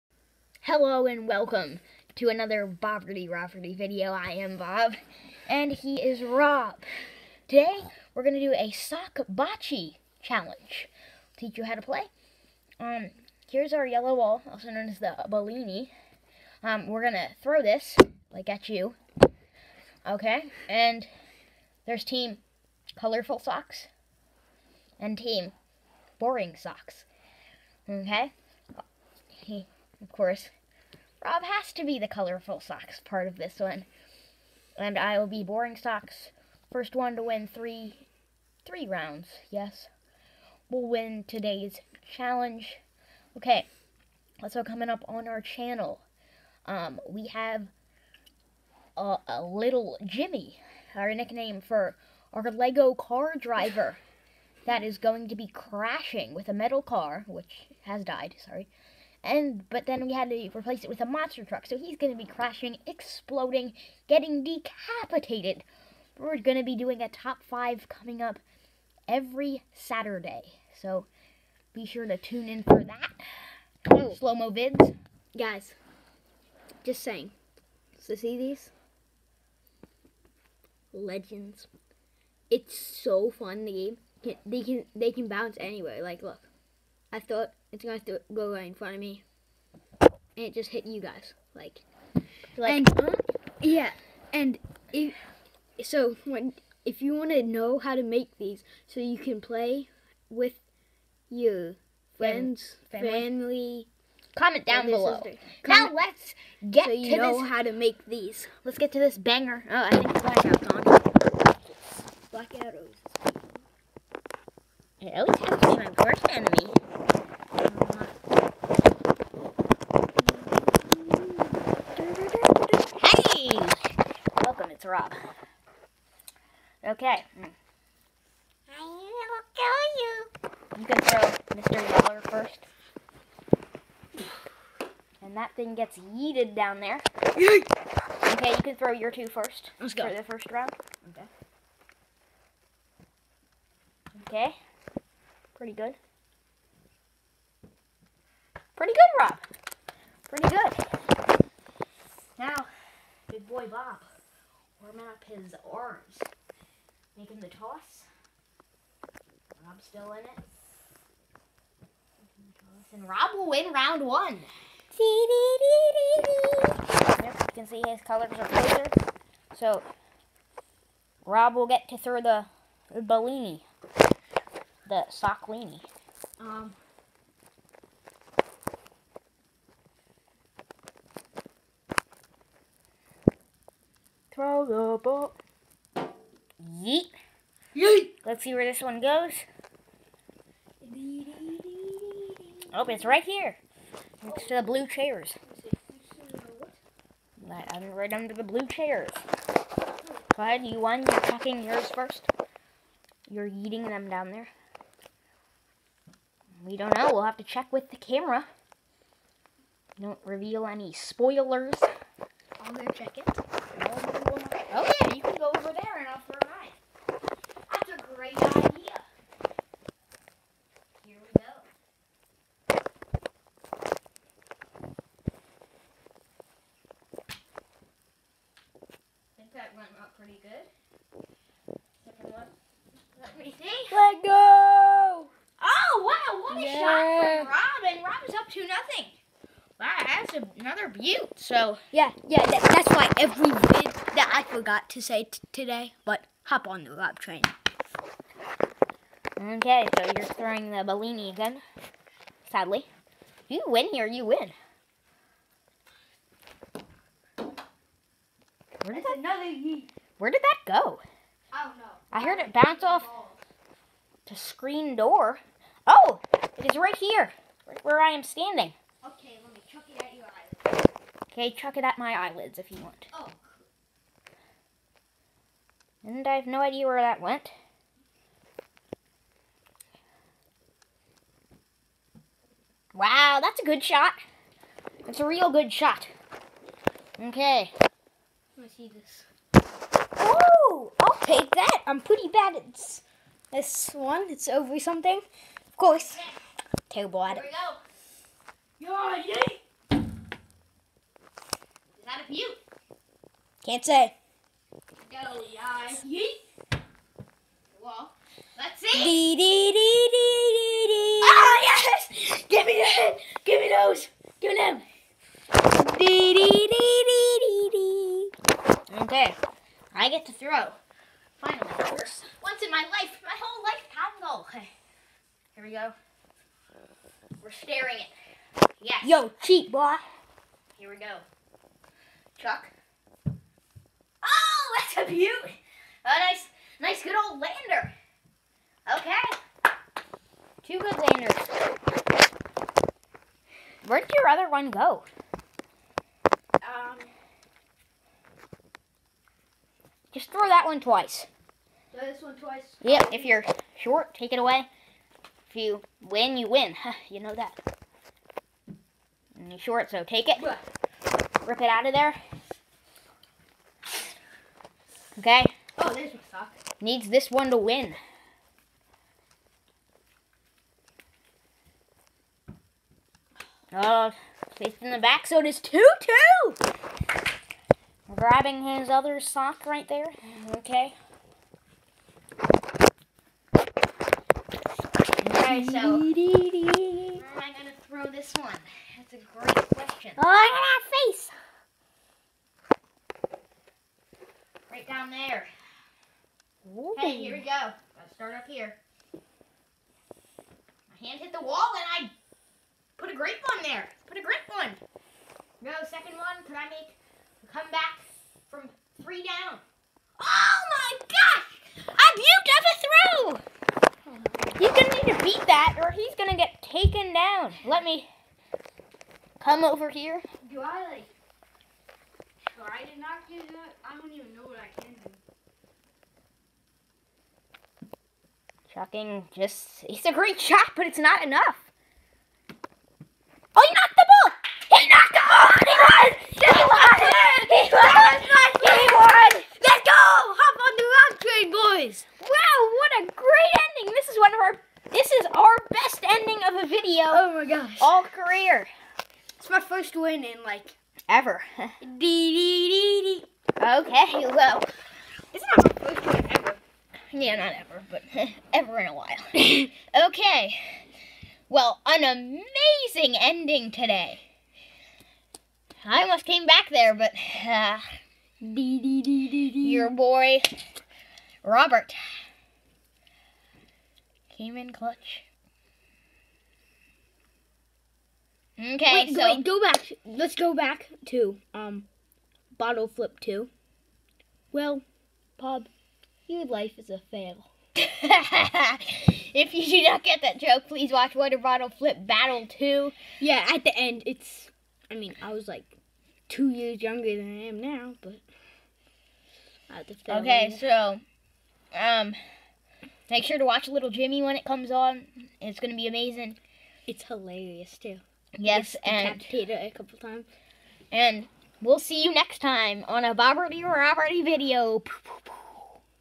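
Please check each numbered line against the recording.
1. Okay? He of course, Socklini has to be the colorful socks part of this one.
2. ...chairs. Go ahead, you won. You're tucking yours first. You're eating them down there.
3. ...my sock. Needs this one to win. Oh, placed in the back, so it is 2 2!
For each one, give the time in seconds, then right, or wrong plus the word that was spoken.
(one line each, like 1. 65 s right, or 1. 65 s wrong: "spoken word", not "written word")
1. 27 s wrong: "Rob", not "Socklini"
2. 198 s right
3. 366 s right.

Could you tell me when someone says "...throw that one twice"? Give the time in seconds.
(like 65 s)
350 s.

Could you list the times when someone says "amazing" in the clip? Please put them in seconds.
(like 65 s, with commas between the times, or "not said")
462 s, 505 s.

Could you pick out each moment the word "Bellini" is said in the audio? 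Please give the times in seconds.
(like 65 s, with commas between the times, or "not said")
15 s, 173 s, 250 s.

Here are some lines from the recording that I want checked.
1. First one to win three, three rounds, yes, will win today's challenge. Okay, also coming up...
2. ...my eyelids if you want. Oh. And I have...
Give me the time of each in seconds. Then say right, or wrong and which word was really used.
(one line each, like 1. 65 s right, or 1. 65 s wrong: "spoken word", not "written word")
1. 36 s right
2. 271 s right.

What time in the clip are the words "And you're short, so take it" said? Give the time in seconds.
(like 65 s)
359 s.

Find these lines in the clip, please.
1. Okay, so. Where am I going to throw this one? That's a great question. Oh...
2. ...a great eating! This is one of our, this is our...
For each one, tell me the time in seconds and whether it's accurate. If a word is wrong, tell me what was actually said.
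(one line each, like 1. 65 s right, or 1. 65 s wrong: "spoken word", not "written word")
1. 383 s right
2. 442 s wrong: "ending", not "eating".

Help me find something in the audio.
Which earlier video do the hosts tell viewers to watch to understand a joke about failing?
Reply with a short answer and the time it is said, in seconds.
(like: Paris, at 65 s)
Water Bottle Flip Battle 2, at 491 s.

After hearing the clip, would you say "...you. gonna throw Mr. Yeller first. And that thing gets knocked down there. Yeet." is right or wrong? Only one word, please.
wrong.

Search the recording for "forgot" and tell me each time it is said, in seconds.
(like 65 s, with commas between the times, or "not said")
244 s.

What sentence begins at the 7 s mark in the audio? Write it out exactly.
Today, we're going to do a sock bocce challenge.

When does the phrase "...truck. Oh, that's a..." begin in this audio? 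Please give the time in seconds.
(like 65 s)
332 s.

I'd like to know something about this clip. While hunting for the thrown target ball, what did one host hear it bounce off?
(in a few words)
Screen door.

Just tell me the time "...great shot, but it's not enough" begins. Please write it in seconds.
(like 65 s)
430 s.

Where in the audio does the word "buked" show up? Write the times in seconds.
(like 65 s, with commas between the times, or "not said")
413 s.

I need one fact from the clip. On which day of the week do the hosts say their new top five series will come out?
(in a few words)
Saturday.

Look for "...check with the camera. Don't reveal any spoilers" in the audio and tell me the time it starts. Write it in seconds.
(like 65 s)
207 s.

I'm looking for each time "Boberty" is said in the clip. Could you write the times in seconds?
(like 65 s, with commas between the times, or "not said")
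2 s, 513 s.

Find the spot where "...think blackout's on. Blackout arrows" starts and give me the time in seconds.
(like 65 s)
109 s.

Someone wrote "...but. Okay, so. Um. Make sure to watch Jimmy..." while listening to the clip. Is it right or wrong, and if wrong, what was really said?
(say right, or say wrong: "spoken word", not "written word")
wrong: "Little", not "Jimmy".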